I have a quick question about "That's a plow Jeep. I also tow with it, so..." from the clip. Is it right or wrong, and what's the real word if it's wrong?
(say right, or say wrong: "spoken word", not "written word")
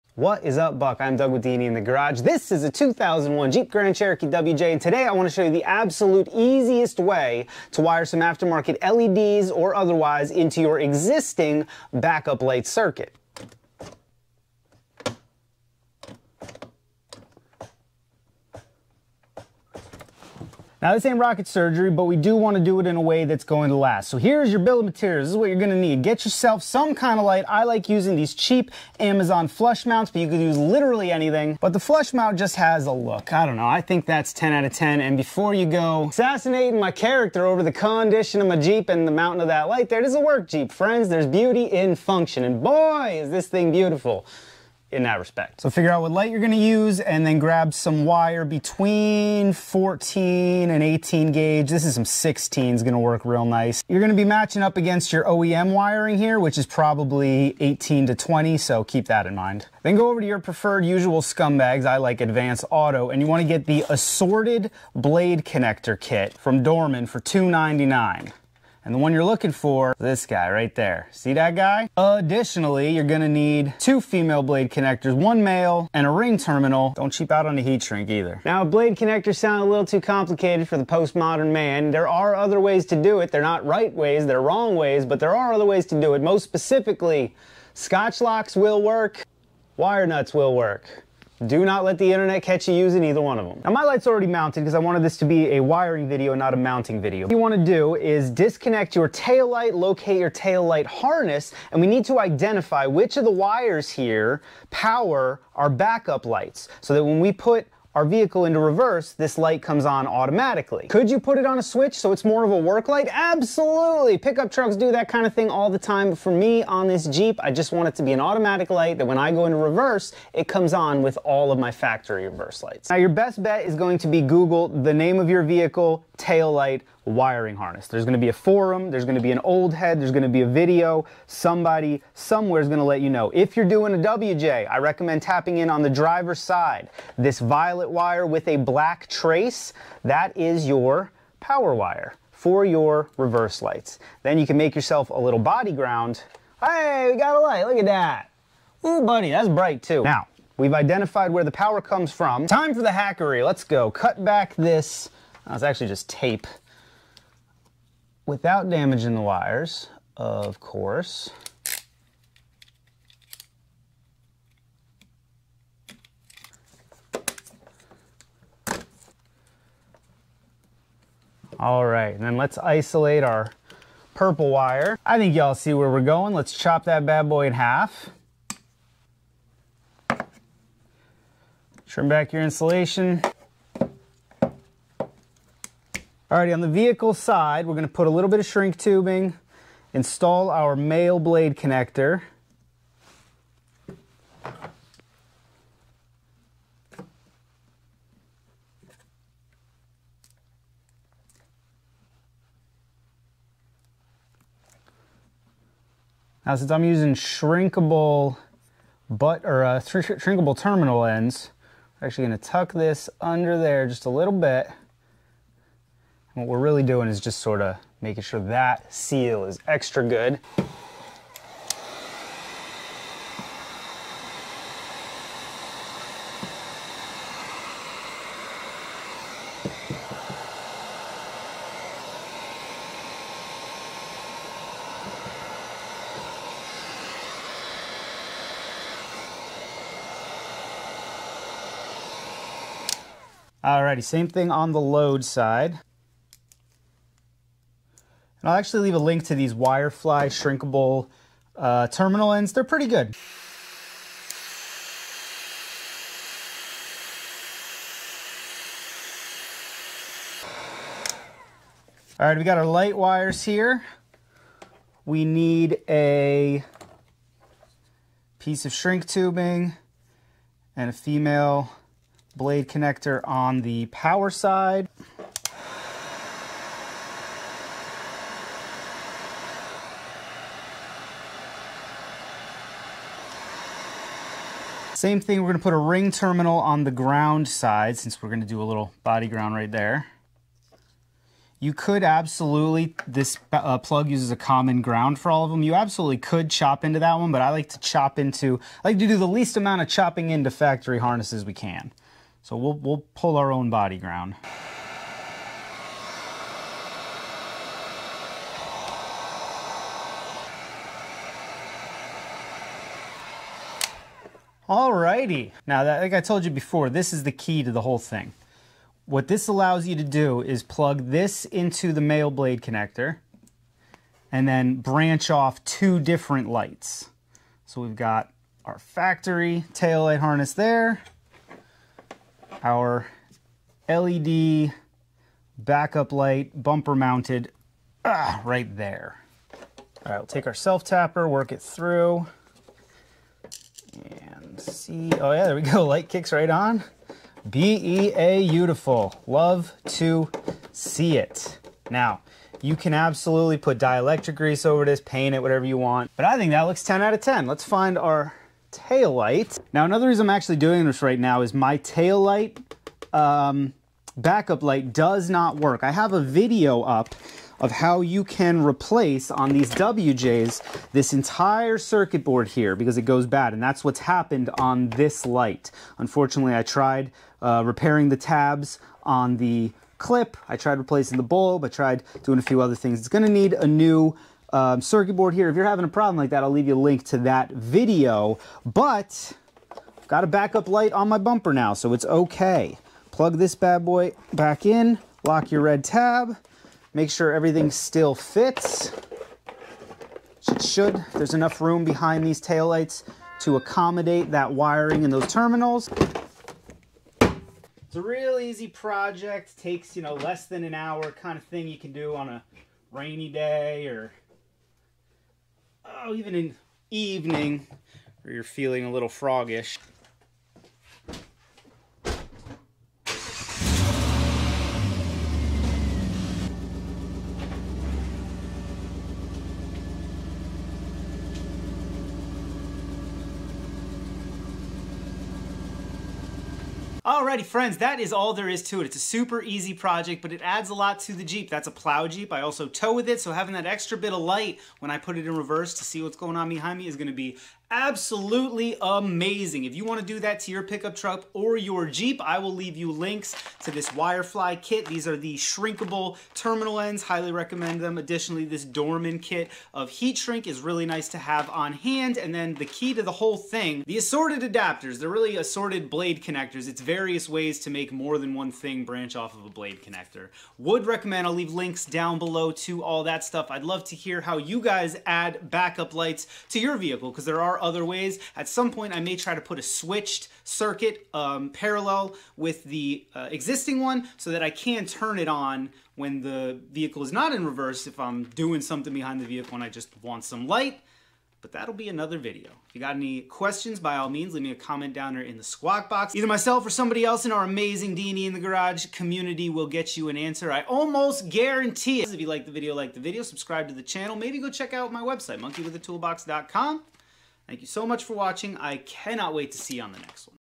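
right.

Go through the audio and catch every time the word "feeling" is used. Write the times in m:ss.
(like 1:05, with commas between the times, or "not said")
6:58.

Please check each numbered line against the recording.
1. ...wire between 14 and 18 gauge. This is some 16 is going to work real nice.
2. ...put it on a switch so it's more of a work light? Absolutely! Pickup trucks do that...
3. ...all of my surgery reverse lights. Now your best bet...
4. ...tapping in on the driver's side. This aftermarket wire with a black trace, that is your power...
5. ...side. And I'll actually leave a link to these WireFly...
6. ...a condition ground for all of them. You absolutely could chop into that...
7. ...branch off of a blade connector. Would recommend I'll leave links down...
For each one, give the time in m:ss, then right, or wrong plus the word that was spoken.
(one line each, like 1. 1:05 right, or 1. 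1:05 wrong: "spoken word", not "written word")
1. 0:48 right
2. 1:51 right
3. 2:01 wrong: "factory", not "surgery"
4. 2:15 wrong: "violet", not "aftermarket"
5. 4:05 right
6. 4:54 wrong: "common", not "condition"
7. 7:48 right.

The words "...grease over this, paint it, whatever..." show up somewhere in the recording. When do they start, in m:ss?
5:54.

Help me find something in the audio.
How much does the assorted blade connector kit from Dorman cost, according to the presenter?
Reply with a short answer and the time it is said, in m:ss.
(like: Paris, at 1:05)
$2.99, at 1:07.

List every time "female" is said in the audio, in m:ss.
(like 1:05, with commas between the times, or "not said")
1:14, 4:30.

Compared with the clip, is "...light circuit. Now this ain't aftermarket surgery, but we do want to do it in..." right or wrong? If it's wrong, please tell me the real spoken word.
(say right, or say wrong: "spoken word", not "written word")
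wrong: "rocket", not "aftermarket".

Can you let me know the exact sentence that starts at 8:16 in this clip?
Either myself or somebody else in our amazing D&E in the Garage community will get you an answer.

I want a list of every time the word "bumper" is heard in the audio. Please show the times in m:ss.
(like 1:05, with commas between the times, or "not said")
5:36, 6:31.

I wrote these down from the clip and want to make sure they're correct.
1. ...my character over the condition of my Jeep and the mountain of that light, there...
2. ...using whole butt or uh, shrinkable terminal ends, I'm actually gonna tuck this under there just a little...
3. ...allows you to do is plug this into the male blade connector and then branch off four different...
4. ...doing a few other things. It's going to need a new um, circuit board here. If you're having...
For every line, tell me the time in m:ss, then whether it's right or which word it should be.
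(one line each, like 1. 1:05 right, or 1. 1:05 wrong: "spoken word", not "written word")
1. 0:36 right
2. 3:26 wrong: "shrinkable", not "whole"
3. 5:19 wrong: "two", not "four"
4. 6:22 right.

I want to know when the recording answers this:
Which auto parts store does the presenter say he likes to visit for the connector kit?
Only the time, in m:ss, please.
1:02.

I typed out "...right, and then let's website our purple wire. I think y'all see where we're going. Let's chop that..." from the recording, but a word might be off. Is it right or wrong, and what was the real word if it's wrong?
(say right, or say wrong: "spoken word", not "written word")
wrong: "isolate", not "website".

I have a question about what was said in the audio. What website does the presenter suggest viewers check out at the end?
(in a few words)
monkeywithatoolbox.com.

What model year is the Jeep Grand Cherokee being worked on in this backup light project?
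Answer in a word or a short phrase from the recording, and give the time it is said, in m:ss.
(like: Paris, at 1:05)
2001, at 0:02.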